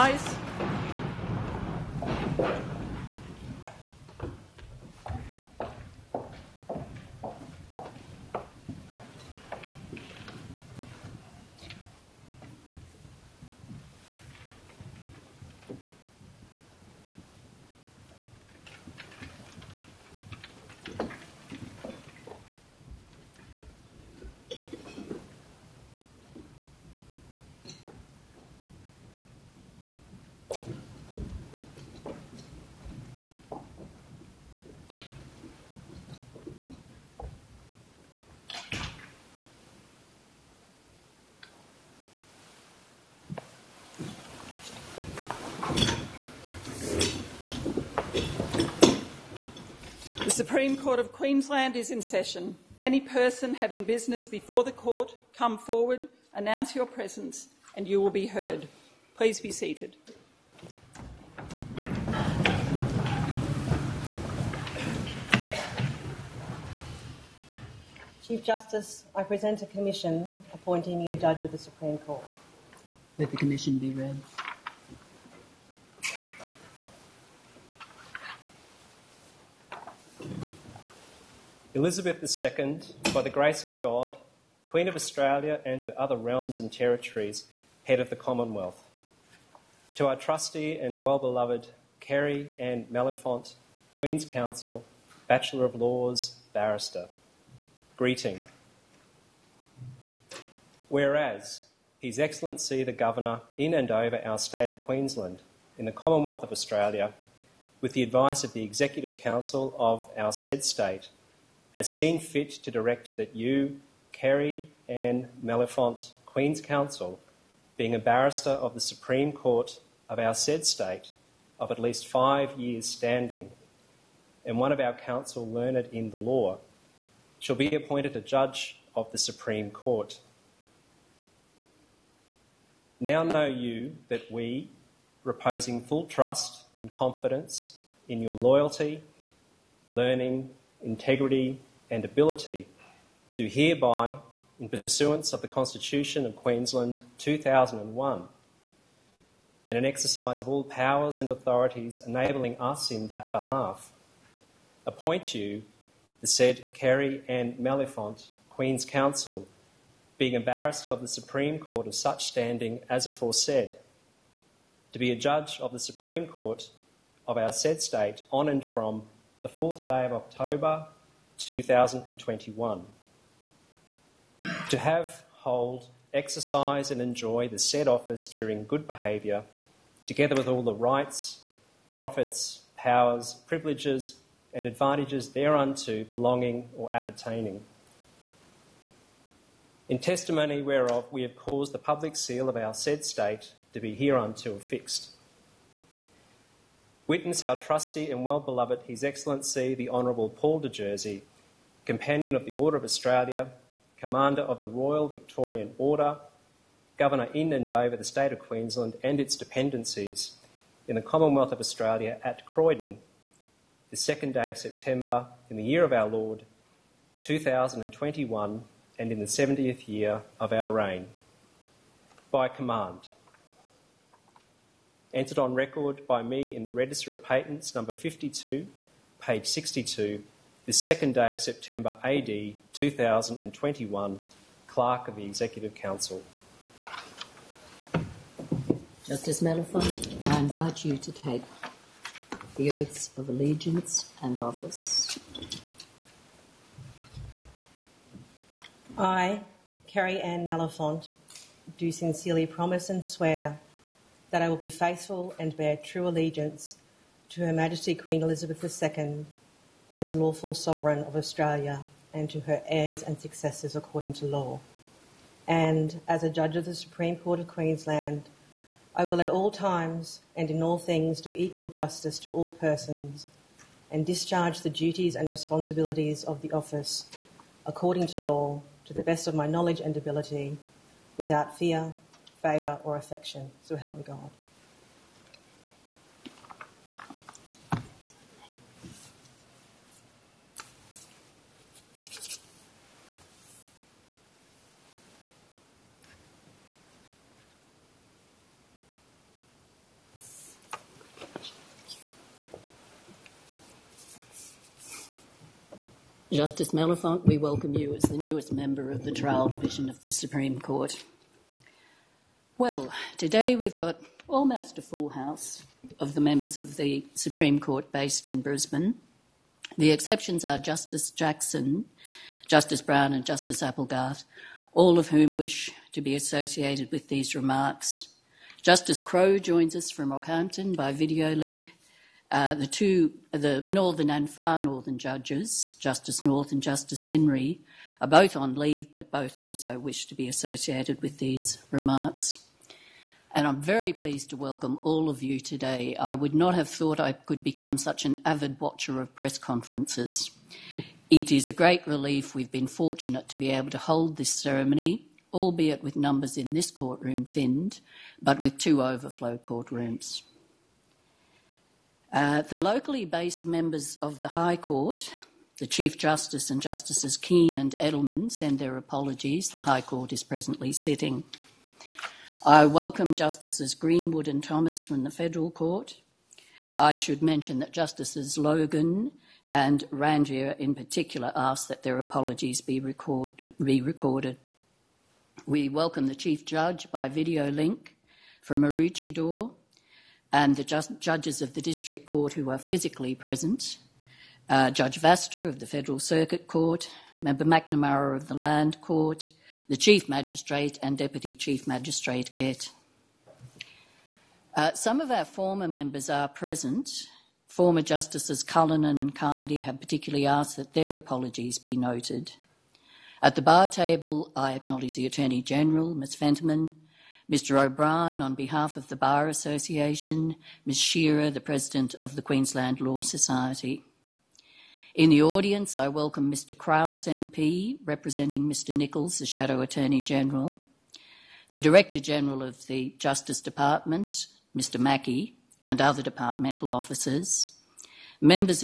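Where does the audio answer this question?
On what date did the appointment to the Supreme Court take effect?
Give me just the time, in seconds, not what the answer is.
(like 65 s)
169 s.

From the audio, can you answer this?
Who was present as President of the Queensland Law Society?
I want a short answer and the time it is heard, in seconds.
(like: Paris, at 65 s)
Ms Shearer, at 420 s.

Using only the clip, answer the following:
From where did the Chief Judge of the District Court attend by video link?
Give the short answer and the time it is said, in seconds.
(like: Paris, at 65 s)
Maroochydore, at 388 s.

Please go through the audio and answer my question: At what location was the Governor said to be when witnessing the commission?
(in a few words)
Croydon.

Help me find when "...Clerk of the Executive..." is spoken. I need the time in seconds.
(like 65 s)
234 s.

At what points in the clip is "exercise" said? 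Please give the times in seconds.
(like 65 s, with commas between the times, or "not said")
149 s, 176 s.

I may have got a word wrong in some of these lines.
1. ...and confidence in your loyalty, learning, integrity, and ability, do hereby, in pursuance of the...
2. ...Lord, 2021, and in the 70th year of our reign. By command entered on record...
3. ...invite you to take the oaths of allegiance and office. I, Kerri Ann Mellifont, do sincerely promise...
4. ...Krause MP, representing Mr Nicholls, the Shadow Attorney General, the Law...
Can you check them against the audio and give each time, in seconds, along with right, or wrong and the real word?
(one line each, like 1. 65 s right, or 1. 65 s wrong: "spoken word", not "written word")
1. 136 s right
2. 216 s right
3. 240 s right
4. 426 s wrong: "Director", not "Law".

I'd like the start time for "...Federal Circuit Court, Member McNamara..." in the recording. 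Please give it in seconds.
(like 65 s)
395 s.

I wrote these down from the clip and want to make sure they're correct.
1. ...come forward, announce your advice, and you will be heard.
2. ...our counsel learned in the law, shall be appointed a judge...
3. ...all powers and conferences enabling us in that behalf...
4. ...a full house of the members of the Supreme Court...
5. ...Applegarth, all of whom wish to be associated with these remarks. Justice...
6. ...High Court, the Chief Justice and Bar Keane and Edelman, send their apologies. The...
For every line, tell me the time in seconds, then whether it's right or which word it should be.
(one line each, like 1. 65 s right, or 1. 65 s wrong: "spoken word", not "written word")
1. 55 s wrong: "presence", not "advice"
2. 124 s right
3. 150 s wrong: "authorities", not "conferences"
4. 314 s right
5. 323 s right
6. 364 s wrong: "Justices", not "Bar".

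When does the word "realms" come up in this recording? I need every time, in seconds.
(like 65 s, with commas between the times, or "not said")
86 s.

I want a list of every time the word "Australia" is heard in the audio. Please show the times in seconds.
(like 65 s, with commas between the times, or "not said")
84 s, 106 s, 202 s, 211 s, 261 s.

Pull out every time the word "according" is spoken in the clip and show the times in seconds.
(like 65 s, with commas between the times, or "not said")
263 s, 277 s.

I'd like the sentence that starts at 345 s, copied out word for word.
I would not have thought I could become such an avid watcher of press conferences.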